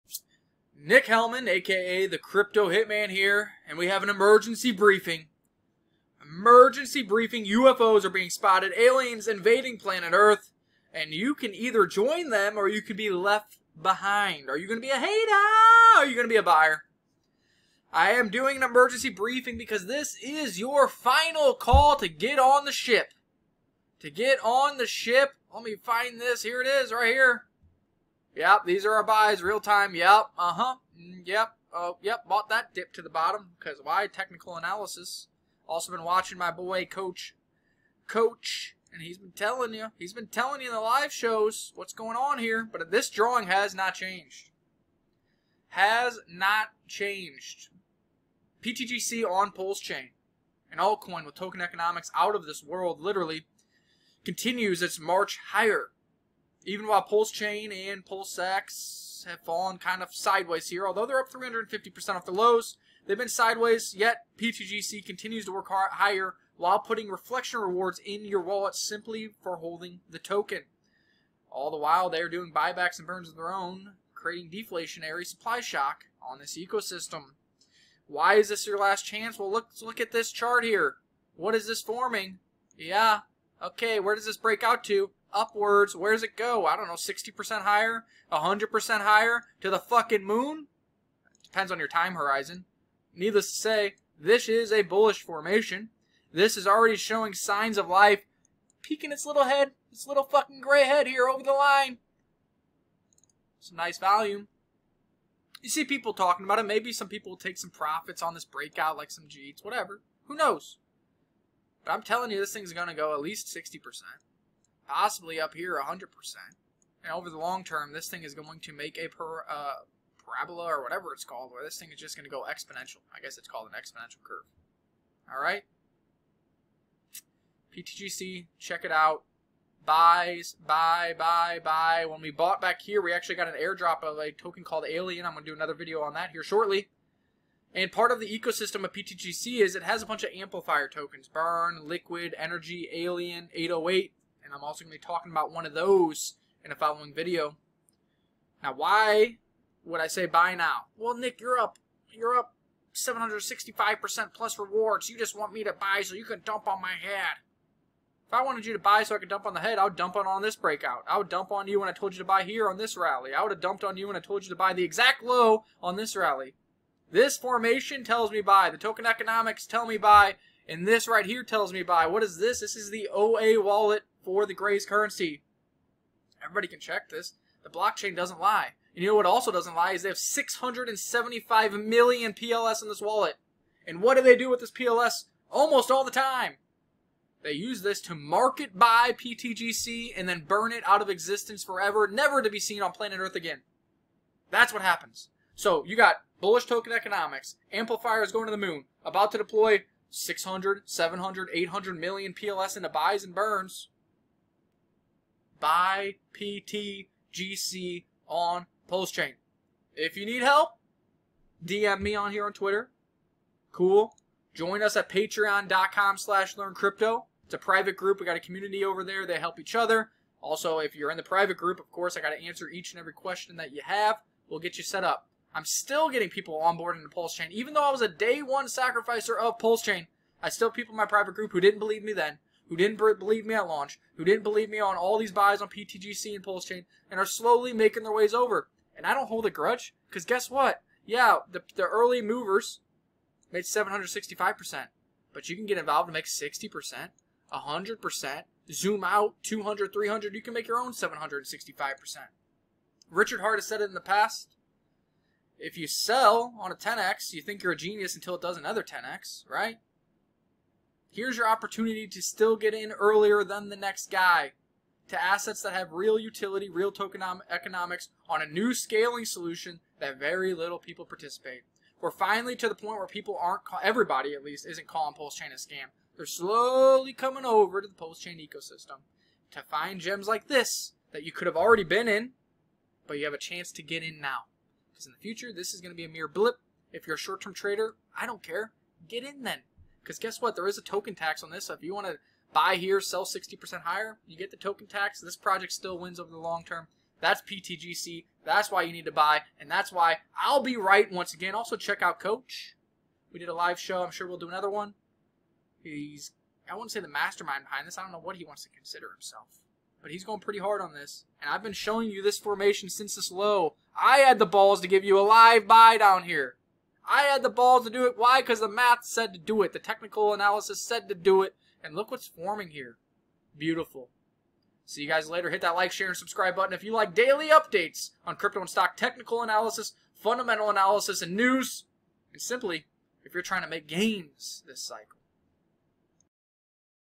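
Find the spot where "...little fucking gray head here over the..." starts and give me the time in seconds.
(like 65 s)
100 s.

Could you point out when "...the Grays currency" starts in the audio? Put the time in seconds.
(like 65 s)
174 s.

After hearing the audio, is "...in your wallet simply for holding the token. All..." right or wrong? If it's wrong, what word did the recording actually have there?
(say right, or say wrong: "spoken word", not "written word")
right.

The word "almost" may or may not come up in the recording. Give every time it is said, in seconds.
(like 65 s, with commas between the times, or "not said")
185 s.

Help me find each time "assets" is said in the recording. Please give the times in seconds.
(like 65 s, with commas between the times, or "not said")
265 s.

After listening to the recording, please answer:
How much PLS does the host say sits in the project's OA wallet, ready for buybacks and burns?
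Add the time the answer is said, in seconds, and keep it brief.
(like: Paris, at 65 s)
675 million, at 180 s.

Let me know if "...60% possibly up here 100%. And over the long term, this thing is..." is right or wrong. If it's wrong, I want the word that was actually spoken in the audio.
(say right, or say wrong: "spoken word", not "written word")
right.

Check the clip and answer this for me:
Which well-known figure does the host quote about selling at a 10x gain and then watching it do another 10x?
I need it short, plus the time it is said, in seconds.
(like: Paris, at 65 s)
Richard Heart, at 253 s.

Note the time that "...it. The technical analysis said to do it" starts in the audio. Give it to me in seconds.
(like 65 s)
319 s.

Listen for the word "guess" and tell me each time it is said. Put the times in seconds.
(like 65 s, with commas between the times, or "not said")
123 s, 240 s, 290 s.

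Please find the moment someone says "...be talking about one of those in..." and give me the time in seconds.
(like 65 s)
144 s.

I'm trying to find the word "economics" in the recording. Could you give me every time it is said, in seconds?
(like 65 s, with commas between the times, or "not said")
51 s, 169 s, 196 s, 267 s.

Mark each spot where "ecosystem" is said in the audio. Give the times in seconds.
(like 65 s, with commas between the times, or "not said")
76 s, 138 s, 278 s.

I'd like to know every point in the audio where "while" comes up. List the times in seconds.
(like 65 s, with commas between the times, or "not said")
56 s, 66 s, 71 s.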